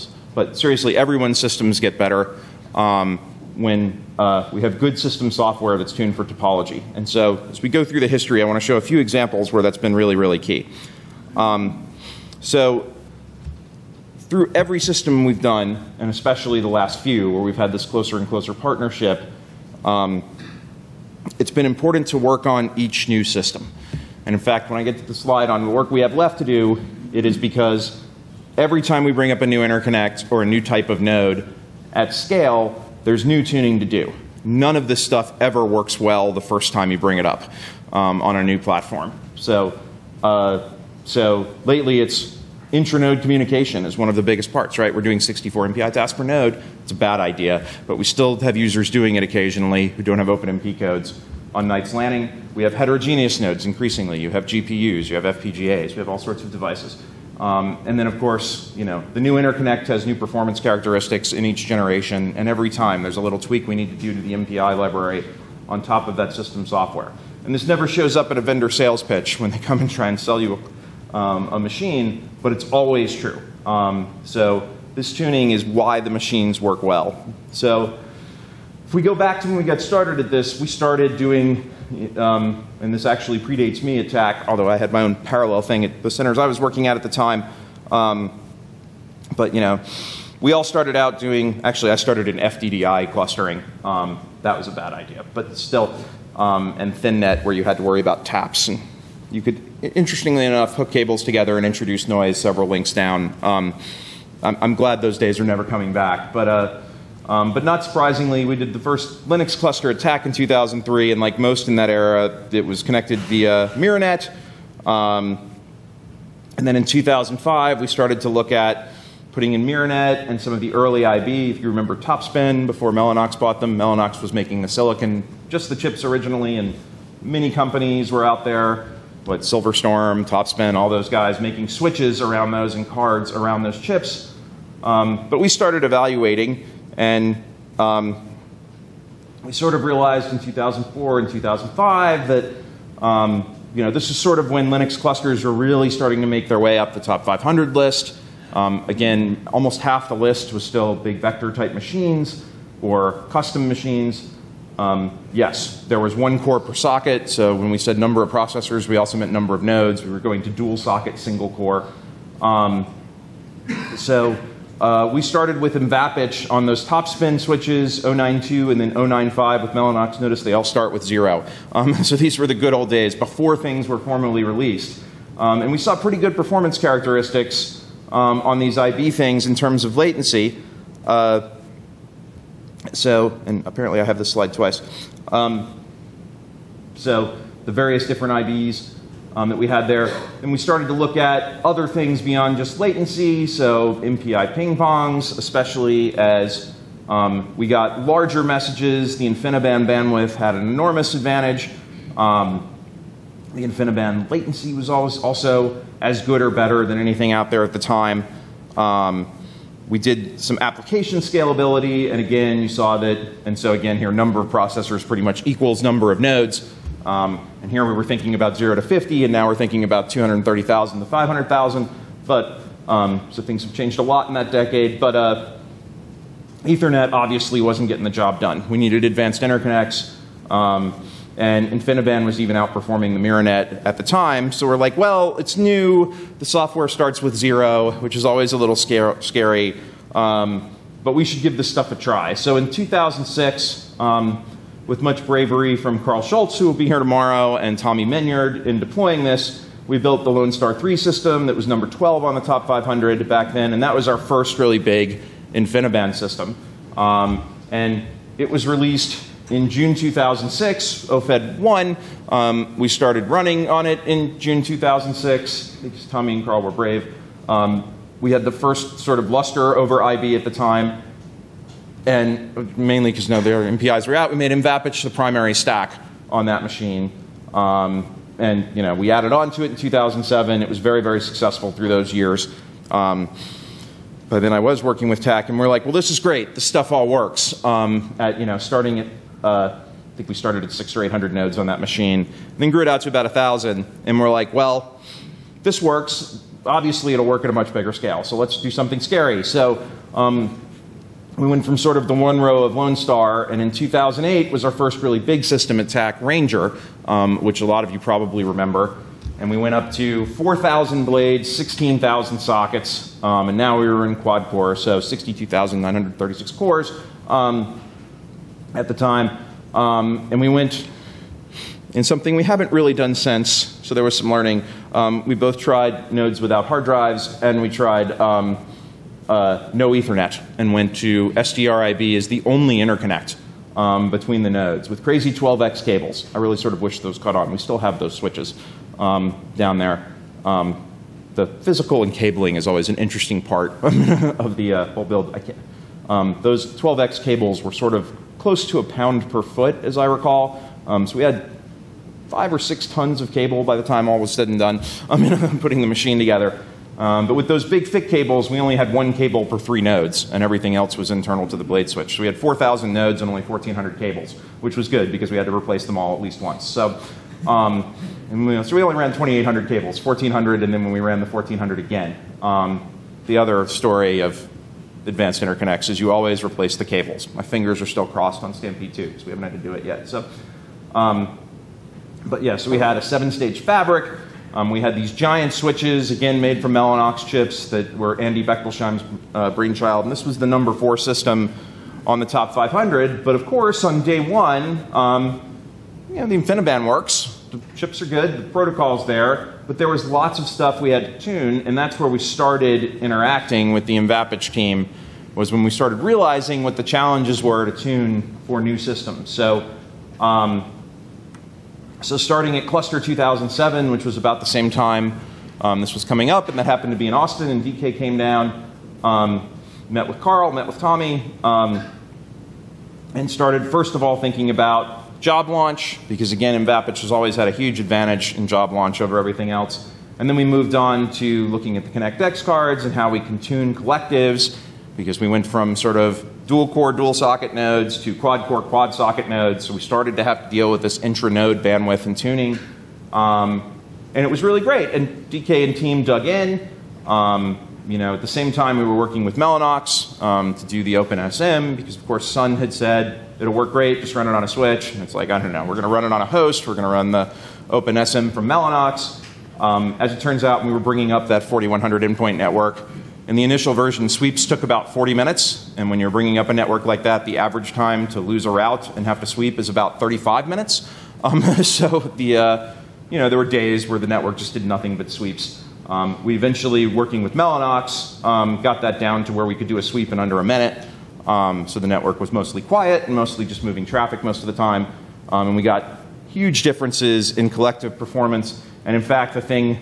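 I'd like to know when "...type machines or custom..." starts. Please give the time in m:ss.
2:31.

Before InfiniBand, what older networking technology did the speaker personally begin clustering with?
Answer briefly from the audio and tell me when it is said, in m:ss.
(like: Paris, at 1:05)
FDDI, at 1:32.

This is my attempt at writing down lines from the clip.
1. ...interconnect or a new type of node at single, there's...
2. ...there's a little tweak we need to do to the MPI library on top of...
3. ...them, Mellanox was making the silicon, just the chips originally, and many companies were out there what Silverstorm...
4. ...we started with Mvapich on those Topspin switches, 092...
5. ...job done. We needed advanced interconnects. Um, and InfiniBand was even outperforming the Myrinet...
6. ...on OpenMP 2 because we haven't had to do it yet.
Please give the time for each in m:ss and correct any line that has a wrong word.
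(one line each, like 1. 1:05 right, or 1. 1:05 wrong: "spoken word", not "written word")
1. 0:29 wrong: "scale", not "single"
2. 1:03 right
3. 2:03 right
4. 2:45 right
5. 3:48 right
6. 6:18 wrong: "Stampede", not "OpenMP".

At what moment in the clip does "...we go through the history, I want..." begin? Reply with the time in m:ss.
0:07.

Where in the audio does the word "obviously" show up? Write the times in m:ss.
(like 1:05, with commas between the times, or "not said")
3:47, 4:56.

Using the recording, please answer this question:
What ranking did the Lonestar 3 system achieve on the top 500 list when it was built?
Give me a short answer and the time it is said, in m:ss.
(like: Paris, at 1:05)
12, at 4:11.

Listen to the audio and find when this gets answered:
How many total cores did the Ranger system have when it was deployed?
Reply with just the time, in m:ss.
5:14.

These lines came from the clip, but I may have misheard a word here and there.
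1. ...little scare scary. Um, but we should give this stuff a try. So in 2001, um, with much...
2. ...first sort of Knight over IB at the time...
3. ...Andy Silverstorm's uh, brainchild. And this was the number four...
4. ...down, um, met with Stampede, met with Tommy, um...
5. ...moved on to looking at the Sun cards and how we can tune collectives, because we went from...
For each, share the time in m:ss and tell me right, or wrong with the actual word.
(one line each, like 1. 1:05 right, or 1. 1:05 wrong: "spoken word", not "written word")
1. 3:58 wrong: "2006", not "2001"
2. 4:28 wrong: "Lustre", not "Knight"
3. 6:28 wrong: "Bechtolsheim", not "Silverstorm"
4. 6:58 wrong: "Karl", not "Stampede"
5. 7:10 wrong: "ConnectX", not "Sun".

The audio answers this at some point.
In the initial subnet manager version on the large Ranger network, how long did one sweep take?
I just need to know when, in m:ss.
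7:44.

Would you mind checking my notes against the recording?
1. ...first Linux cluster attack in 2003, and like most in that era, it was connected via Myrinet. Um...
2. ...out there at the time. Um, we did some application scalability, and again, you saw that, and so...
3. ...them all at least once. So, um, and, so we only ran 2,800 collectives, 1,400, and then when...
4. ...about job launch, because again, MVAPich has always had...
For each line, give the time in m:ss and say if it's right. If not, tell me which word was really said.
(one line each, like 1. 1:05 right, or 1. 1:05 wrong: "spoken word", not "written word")
1. 1:48 right
2. 3:27 right
3. 6:05 wrong: "cables", not "collectives"
4. 7:04 right.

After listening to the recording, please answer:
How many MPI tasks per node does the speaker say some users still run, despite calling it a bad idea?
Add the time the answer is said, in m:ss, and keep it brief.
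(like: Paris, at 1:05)
64, at 0:45.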